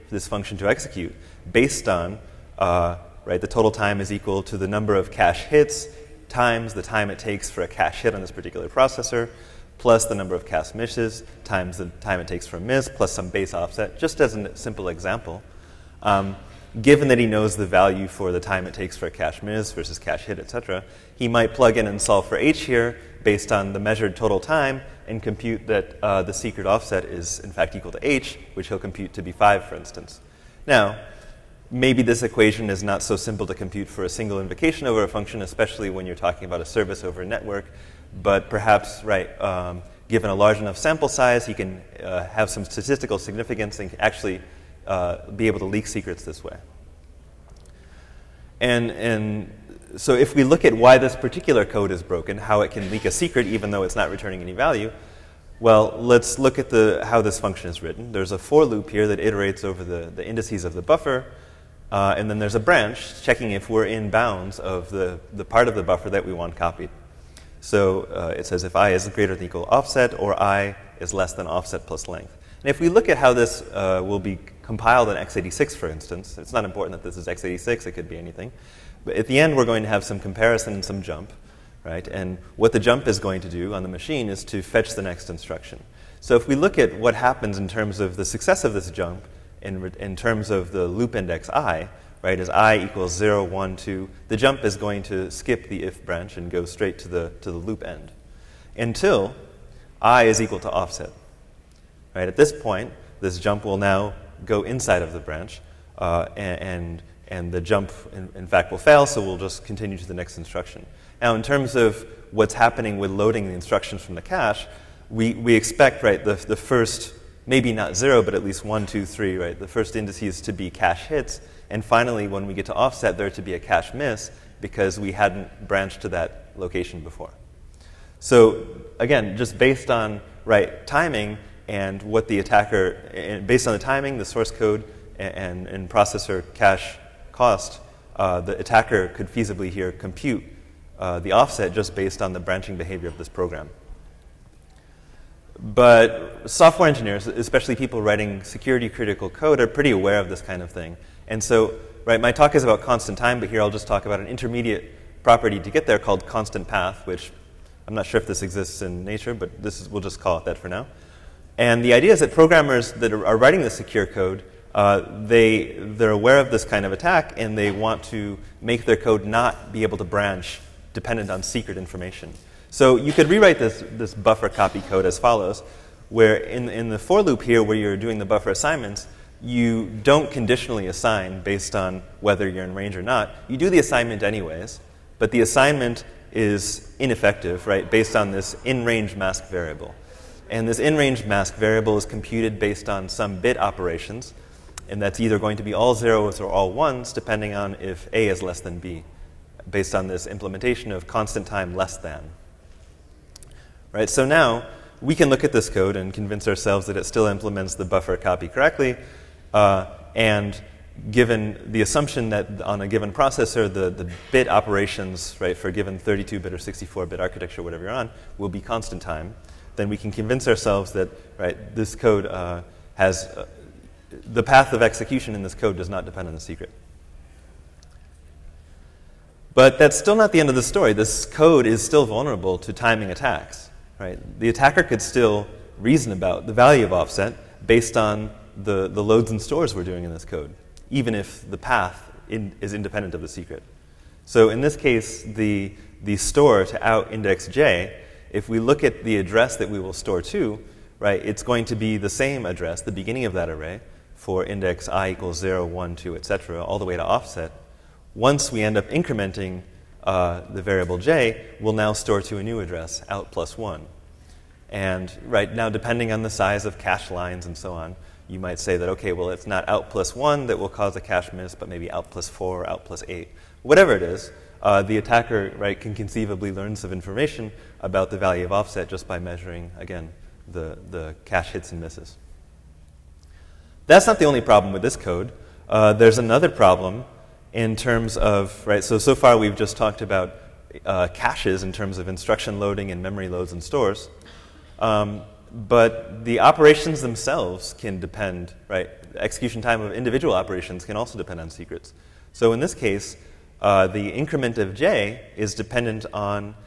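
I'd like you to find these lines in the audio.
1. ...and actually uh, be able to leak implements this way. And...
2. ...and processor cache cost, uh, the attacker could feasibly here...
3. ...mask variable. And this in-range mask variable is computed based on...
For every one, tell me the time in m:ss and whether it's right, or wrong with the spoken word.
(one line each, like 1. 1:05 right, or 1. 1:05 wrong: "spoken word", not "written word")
1. 0:43 wrong: "secrets", not "implements"
2. 2:15 right
3. 3:09 right.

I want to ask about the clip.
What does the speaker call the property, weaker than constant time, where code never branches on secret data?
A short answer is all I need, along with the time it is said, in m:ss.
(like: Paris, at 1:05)
constant path, at 2:36.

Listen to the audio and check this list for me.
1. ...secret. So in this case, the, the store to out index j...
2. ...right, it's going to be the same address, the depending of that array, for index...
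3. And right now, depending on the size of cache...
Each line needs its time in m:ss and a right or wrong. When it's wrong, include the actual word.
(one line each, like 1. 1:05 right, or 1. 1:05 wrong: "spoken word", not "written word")
1. 4:03 right
2. 4:10 wrong: "beginning", not "depending"
3. 4:24 right.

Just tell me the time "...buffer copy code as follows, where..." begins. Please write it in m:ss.
2:54.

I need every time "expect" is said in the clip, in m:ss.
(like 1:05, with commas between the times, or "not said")
1:55.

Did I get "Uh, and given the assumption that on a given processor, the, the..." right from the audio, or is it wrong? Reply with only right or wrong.
right.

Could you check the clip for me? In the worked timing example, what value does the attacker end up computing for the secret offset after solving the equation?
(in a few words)
5.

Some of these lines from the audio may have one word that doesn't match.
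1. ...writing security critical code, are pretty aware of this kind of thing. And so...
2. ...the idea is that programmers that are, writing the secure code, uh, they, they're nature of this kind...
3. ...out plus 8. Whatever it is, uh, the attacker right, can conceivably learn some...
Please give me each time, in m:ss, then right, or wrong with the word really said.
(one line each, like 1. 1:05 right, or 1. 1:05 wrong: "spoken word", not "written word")
1. 2:28 right
2. 2:41 wrong: "aware", not "nature"
3. 4:32 right.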